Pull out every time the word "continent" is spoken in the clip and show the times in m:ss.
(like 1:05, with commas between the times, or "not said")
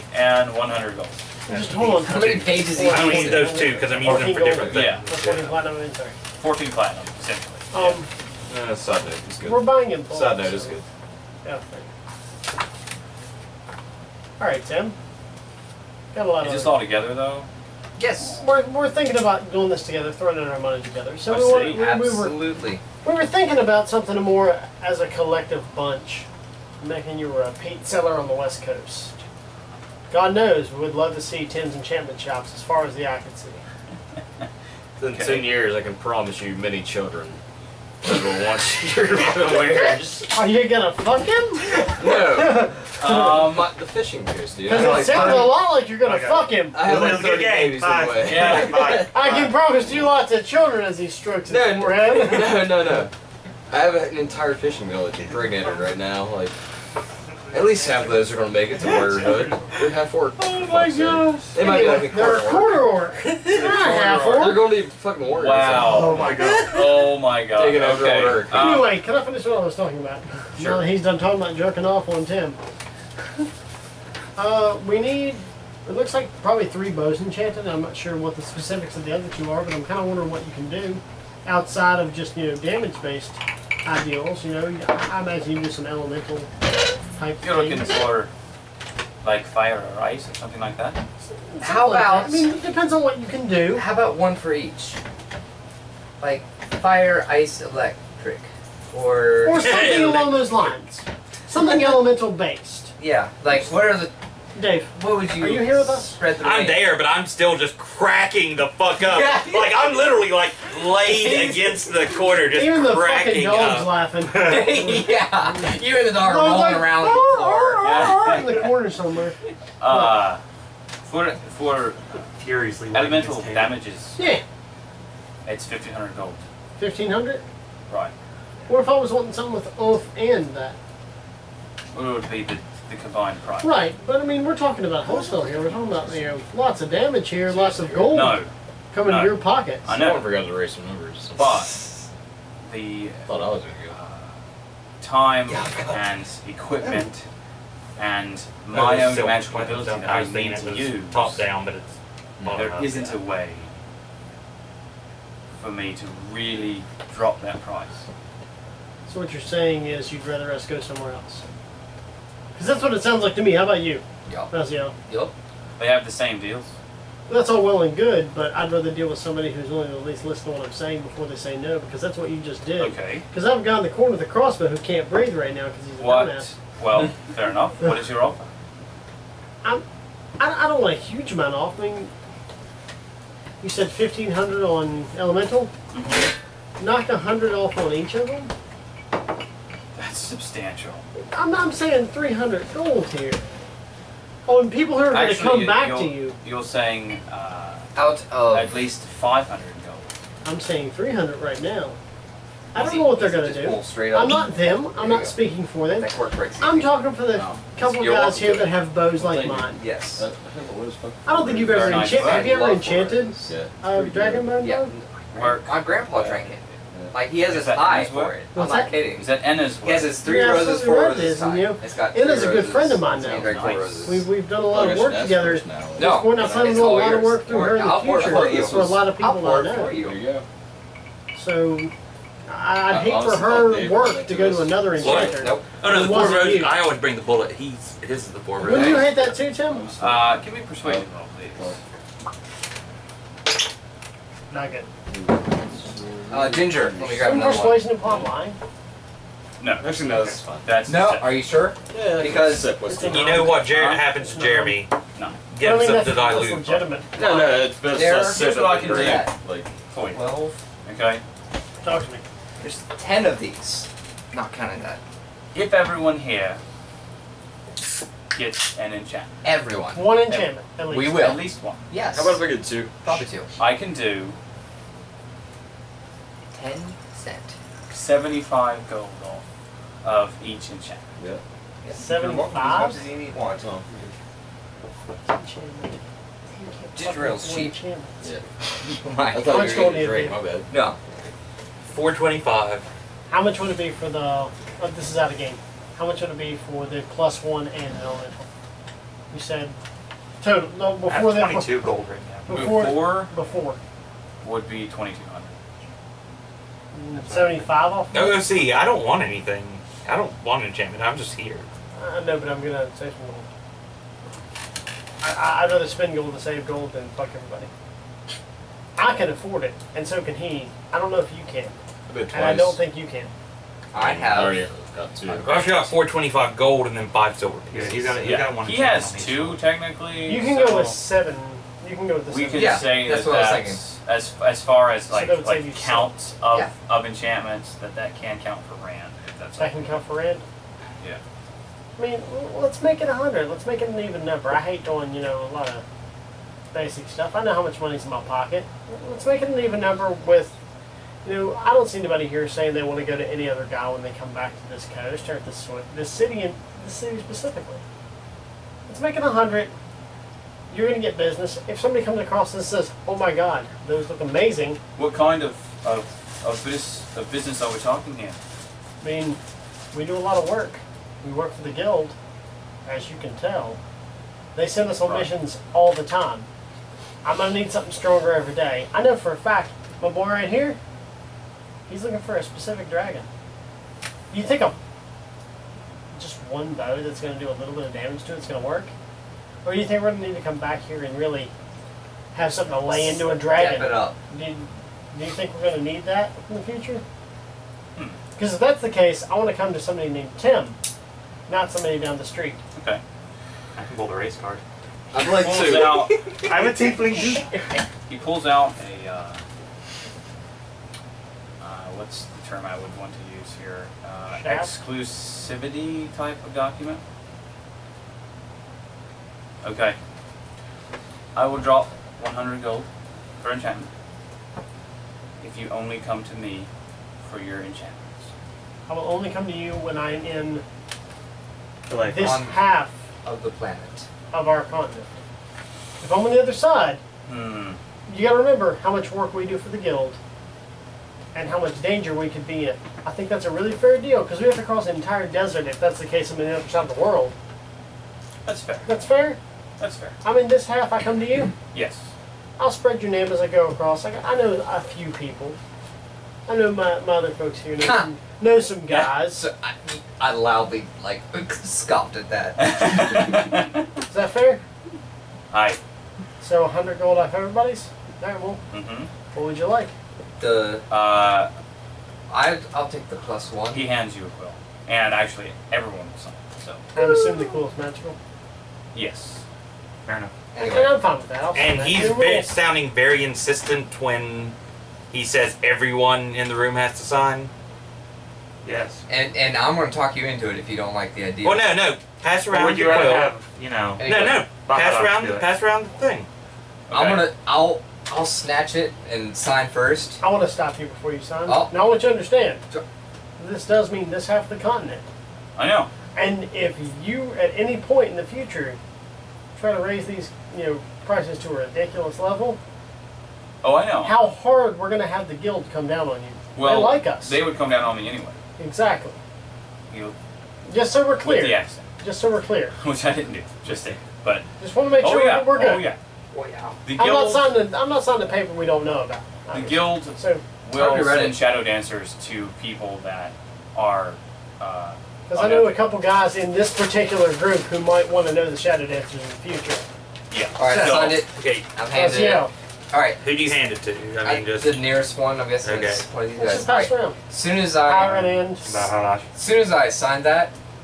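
7:14, 8:24.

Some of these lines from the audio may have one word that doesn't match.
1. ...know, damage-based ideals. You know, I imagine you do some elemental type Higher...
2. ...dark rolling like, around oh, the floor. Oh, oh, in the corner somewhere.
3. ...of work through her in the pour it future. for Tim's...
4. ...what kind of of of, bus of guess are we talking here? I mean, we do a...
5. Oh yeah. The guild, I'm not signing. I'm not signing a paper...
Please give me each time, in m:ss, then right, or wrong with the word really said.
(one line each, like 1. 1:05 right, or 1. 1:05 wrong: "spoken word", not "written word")
1. 1:22 wrong: "You", not "Higher"
2. 1:56 right
3. 3:47 wrong: "That", not "Tim"
4. 6:04 wrong: "business", not "guess"
5. 8:46 right.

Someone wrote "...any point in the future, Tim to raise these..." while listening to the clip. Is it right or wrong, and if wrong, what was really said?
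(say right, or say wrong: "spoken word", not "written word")
wrong: "Try", not "Tim".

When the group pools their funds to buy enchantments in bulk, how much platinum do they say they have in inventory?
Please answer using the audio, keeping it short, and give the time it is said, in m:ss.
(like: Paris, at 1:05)
14 platinum, at 0:05.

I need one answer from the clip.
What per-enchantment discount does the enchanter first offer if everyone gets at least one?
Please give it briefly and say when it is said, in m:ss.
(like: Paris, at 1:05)
75 gold, at 4:37.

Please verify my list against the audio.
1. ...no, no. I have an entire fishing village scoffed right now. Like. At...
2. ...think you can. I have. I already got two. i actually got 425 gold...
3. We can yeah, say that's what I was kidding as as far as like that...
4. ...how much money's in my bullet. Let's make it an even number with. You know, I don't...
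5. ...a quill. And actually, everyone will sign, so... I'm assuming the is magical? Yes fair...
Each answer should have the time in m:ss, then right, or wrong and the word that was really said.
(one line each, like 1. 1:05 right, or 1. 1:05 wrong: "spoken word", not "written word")
1. 0:52 wrong: "impregnated", not "scoffed"
2. 5:22 right
3. 5:32 wrong: "thinking", not "kidding"
4. 5:47 wrong: "pocket", not "bullet"
5. 7:54 right.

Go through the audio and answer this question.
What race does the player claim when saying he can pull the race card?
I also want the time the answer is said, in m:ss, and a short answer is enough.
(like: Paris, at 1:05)
Tiefling, at 6:46.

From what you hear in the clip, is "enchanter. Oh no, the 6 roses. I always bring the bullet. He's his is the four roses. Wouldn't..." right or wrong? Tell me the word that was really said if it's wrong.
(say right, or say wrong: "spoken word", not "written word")
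wrong: "4", not "6".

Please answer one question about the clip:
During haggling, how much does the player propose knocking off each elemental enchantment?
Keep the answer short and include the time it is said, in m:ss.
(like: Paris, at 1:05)
100, at 3:06.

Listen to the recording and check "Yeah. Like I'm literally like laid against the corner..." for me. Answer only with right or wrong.
right.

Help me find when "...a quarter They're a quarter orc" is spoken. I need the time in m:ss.
1:02.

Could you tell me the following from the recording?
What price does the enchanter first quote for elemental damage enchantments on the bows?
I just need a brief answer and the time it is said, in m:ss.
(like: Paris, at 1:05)
1500 gold, at 2:05.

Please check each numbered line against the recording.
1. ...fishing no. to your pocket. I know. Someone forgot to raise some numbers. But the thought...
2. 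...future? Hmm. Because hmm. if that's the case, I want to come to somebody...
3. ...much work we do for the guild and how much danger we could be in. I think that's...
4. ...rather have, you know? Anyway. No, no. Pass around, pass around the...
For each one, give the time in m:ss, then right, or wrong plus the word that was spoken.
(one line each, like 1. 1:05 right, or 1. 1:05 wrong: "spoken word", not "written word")
1. 2:18 wrong: "coming", not "fishing"
2. 6:36 right
3. 7:18 right
4. 8:12 right.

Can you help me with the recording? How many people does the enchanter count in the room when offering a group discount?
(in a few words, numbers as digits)
10.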